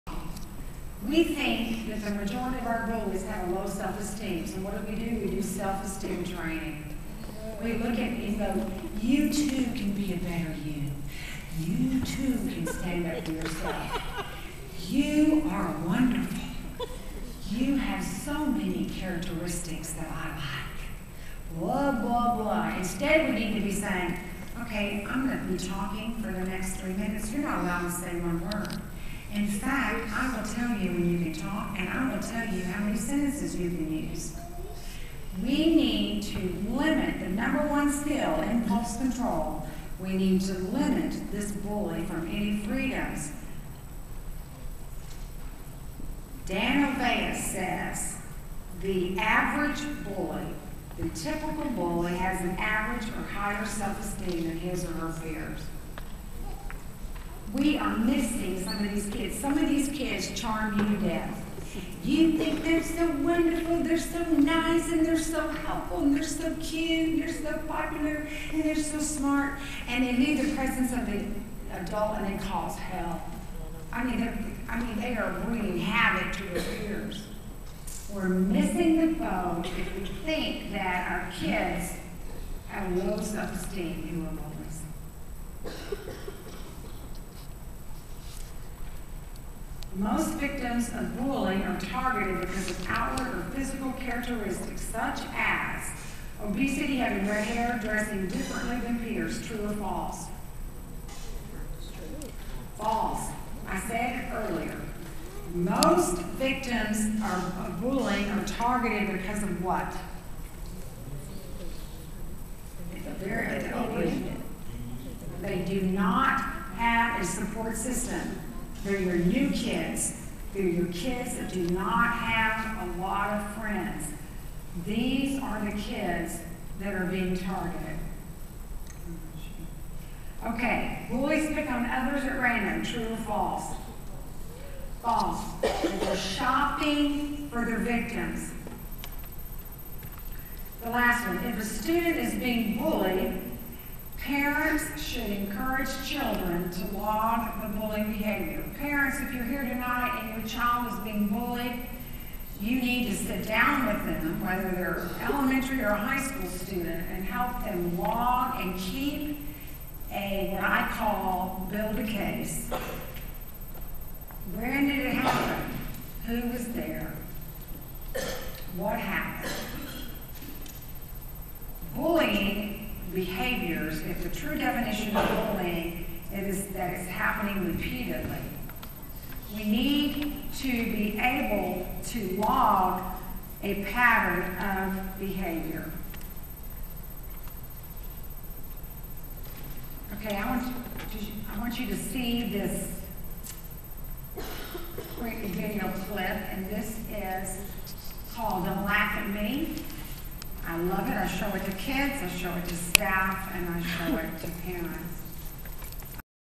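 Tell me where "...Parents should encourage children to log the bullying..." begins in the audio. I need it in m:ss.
2:24.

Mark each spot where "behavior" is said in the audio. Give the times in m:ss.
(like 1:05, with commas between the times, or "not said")
2:28, 3:05.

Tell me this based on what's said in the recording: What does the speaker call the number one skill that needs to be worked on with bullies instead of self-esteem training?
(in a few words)
Impulse control.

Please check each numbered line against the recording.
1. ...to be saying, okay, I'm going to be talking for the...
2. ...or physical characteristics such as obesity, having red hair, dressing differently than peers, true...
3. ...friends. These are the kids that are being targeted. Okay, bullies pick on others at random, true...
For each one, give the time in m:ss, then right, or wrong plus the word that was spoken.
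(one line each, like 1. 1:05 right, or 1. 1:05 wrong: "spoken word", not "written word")
1. 0:23 right
2. 1:33 right
3. 2:03 right.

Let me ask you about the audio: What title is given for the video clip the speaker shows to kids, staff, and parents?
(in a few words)
Don't Laugh at Me.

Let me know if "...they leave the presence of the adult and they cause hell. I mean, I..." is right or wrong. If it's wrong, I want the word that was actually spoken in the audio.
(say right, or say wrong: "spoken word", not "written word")
right.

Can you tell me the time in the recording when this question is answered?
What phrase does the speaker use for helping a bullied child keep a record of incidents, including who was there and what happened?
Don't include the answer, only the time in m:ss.
2:41.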